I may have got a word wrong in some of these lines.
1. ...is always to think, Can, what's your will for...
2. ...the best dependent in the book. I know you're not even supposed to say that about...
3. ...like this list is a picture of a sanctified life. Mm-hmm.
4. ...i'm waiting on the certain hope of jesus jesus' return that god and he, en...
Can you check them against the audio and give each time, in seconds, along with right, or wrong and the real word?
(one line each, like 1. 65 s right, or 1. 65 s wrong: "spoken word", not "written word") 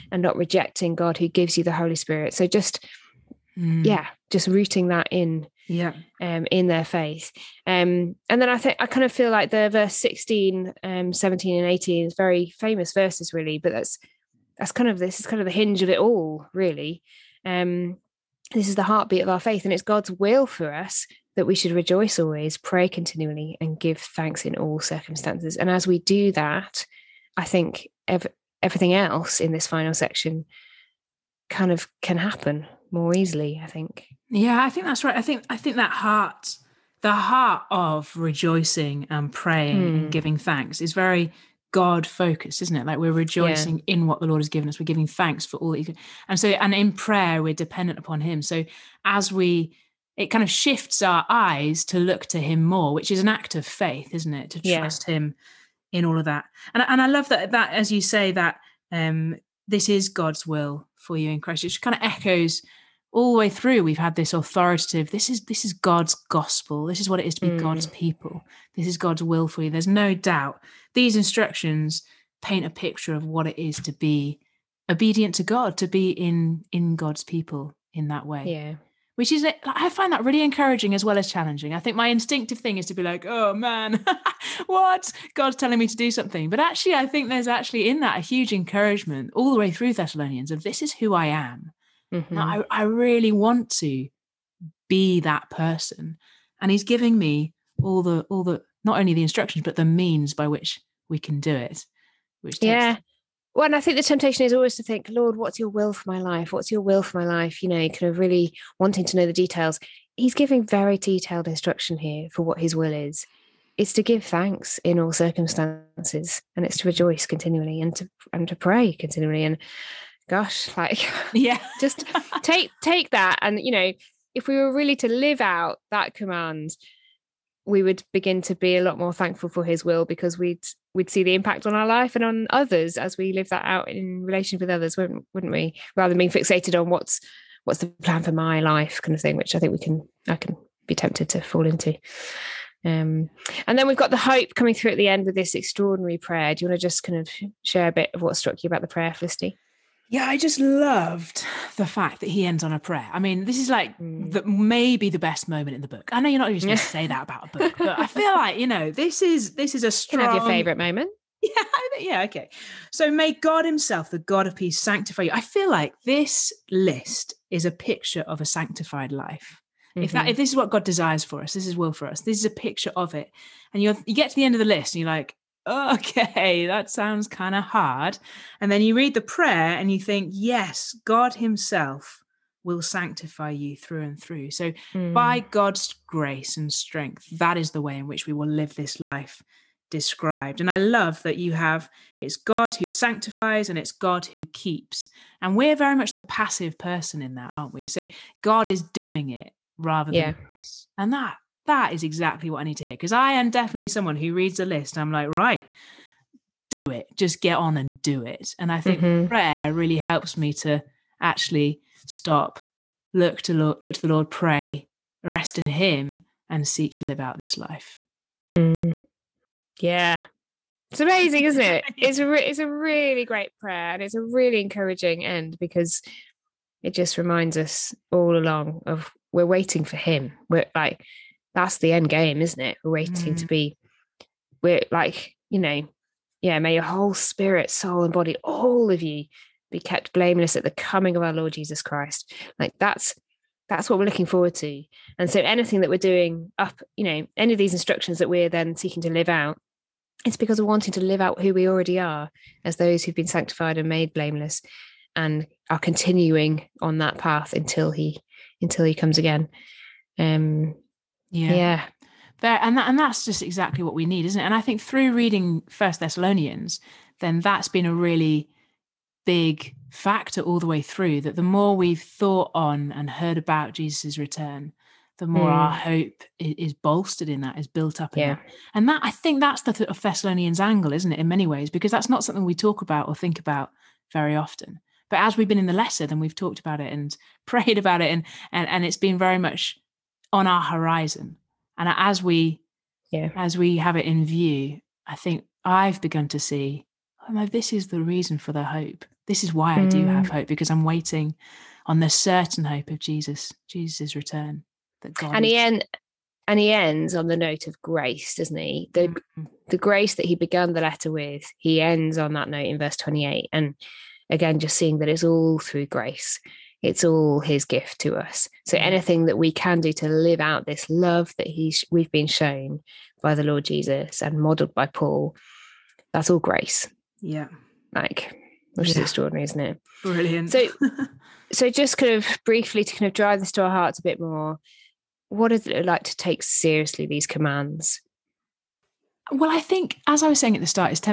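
1. 104 s wrong: "Lord", not "Can"
2. 155 s wrong: "moment", not "dependent"
3. 165 s right
4. 300 s right.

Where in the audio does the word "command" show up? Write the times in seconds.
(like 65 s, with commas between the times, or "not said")
126 s, 337 s.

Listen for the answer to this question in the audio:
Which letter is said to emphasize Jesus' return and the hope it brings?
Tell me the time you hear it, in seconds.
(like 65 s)
265 s.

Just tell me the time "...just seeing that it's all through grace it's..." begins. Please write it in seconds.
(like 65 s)
314 s.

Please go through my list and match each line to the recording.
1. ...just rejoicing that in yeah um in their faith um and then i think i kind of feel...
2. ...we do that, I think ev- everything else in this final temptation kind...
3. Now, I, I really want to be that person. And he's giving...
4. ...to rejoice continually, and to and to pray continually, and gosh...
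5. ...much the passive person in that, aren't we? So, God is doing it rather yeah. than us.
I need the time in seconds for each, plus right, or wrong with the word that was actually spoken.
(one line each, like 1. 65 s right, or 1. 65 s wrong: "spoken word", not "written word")
1. 4 s wrong: "rooting", not "rejoicing"
2. 25 s wrong: "section", not "temptation"
3. 92 s right
4. 116 s right
5. 195 s right.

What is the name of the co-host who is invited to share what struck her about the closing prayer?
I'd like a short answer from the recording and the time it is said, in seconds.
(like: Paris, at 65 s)
Felicity, at 149 s.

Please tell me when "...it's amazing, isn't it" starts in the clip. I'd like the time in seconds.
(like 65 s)
220 s.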